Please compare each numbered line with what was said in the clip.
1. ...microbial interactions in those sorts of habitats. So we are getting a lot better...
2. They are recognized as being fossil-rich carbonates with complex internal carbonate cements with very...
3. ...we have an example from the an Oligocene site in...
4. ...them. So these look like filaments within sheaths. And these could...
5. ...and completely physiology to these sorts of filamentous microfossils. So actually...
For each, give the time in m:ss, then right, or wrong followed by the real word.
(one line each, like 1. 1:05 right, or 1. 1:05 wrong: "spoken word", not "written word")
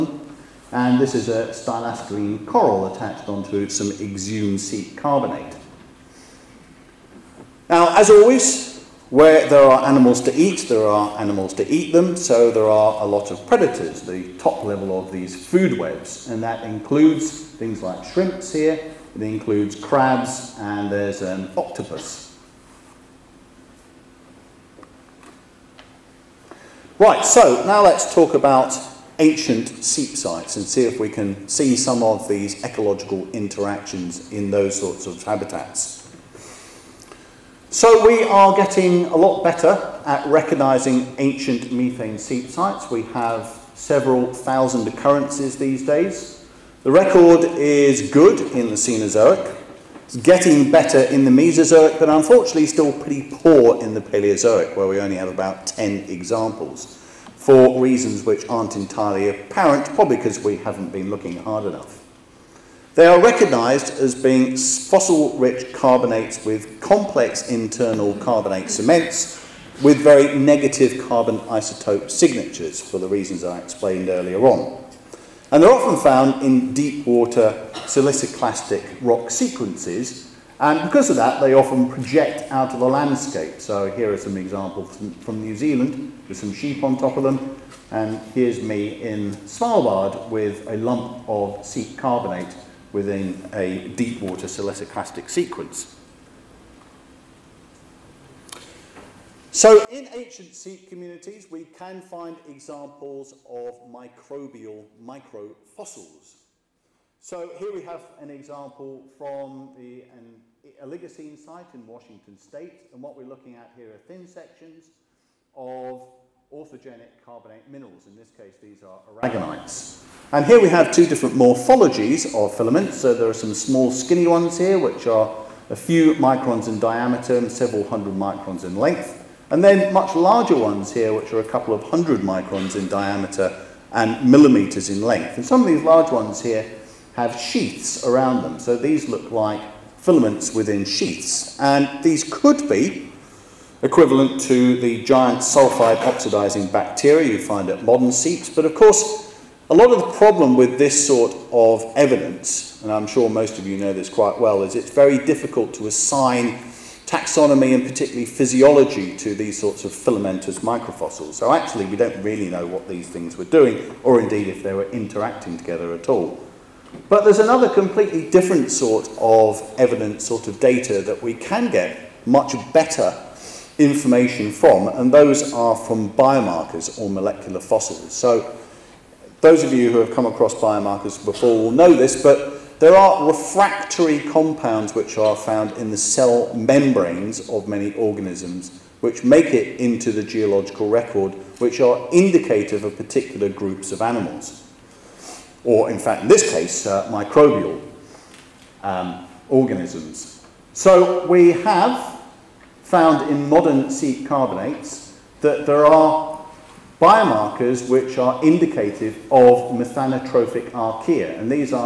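1. 0:32 wrong: "ecological", not "microbial"
2. 1:02 right
3. 1:47 right
4. 2:18 right
5. 2:37 wrong: "particularly", not "completely".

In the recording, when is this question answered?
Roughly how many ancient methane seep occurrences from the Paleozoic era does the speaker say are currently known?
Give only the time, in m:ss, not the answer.
0:55.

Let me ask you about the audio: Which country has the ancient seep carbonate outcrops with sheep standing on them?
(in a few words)
New Zealand.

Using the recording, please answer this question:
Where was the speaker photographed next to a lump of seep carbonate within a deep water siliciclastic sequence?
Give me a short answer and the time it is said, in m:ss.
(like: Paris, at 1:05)
Svalbard, at 1:29.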